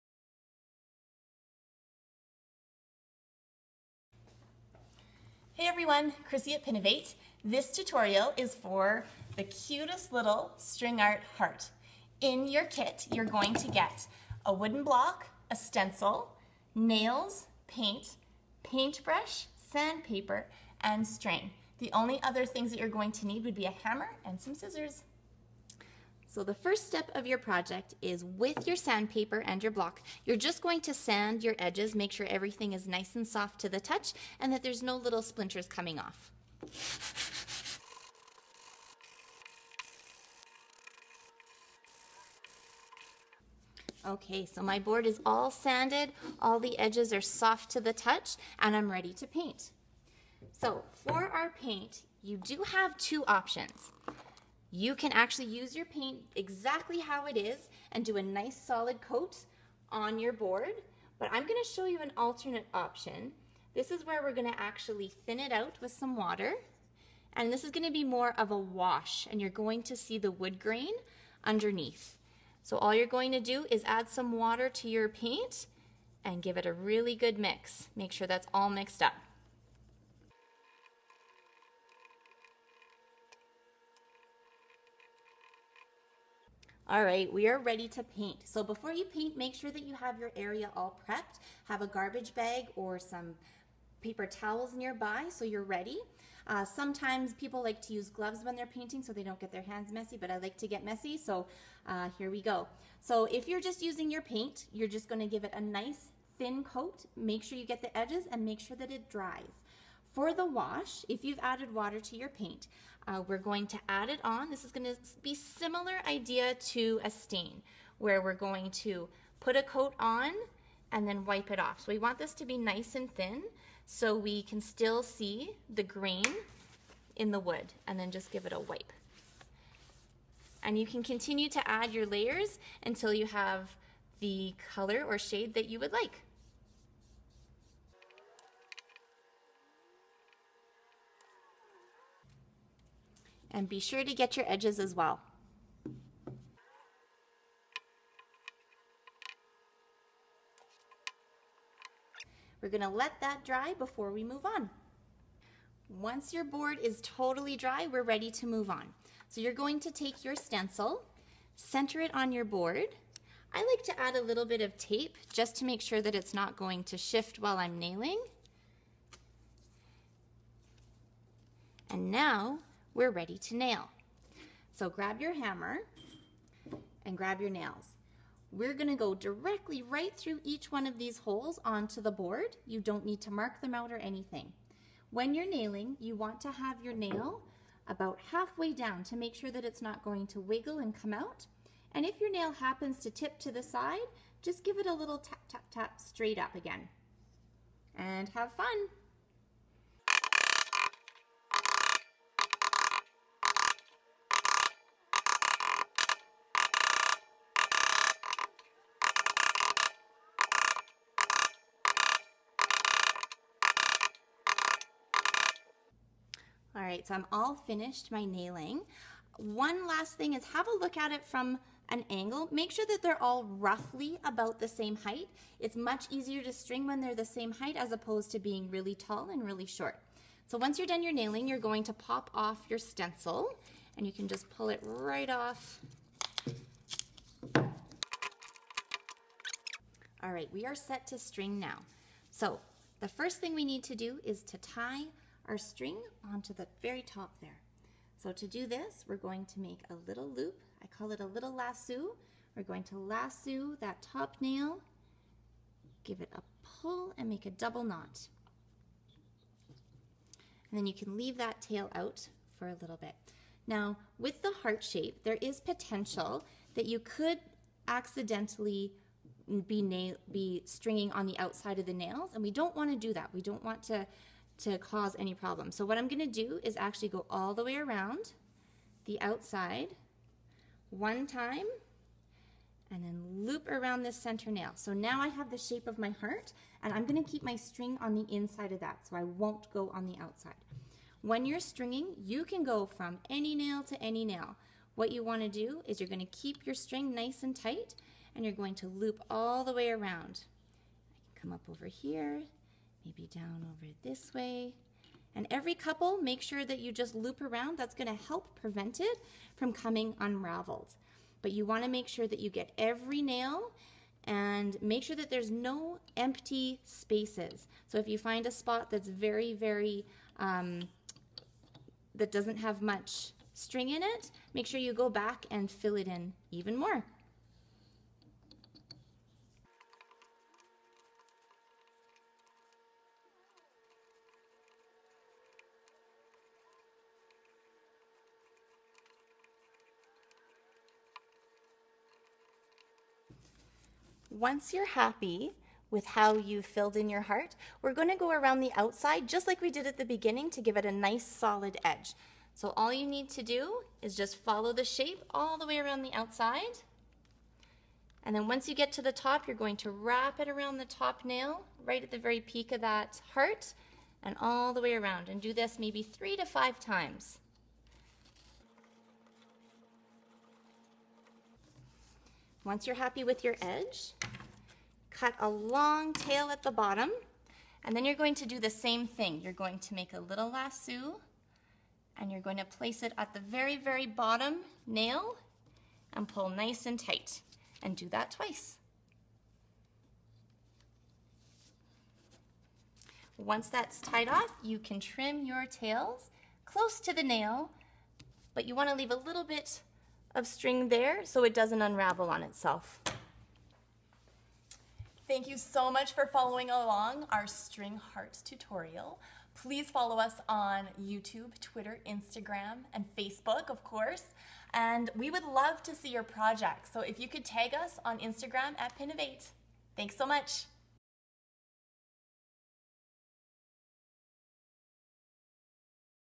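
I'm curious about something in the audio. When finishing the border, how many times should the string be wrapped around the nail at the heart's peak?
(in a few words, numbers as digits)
3 to 5 times.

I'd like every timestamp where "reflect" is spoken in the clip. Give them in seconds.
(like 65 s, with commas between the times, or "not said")
not said.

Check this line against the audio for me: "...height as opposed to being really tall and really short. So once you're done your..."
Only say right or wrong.
right.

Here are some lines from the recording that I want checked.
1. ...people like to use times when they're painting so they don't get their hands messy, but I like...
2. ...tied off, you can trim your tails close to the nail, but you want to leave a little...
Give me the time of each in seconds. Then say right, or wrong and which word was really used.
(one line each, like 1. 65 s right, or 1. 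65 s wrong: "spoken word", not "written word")
1. 97 s wrong: "gloves", not "times"
2. 394 s right.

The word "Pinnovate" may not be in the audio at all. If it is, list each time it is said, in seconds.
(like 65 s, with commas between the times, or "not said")
6 s, 418 s.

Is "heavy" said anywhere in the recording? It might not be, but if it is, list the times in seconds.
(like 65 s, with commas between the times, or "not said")
not said.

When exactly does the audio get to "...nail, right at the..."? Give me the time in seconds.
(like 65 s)
361 s.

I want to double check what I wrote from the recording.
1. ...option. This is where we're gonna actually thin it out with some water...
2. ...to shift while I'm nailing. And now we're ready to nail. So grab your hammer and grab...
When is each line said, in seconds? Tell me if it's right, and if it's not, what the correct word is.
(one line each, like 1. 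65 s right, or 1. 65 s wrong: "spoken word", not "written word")
1. 62 s right
2. 166 s right.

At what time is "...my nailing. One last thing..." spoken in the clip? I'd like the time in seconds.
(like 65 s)
218 s.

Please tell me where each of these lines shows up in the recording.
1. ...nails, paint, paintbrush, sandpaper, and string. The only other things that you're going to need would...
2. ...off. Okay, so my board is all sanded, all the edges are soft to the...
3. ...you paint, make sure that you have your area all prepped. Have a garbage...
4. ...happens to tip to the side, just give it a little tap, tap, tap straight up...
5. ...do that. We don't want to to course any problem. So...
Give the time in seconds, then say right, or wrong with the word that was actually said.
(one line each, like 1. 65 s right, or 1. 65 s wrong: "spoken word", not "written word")
1. 16 s right
2. 35 s right
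3. 88 s right
4. 192 s right
5. 272 s wrong: "cause", not "course".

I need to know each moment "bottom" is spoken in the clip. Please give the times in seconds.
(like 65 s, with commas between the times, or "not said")
376 s, 384 s.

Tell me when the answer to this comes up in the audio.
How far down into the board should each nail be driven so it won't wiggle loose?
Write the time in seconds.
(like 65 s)
188 s.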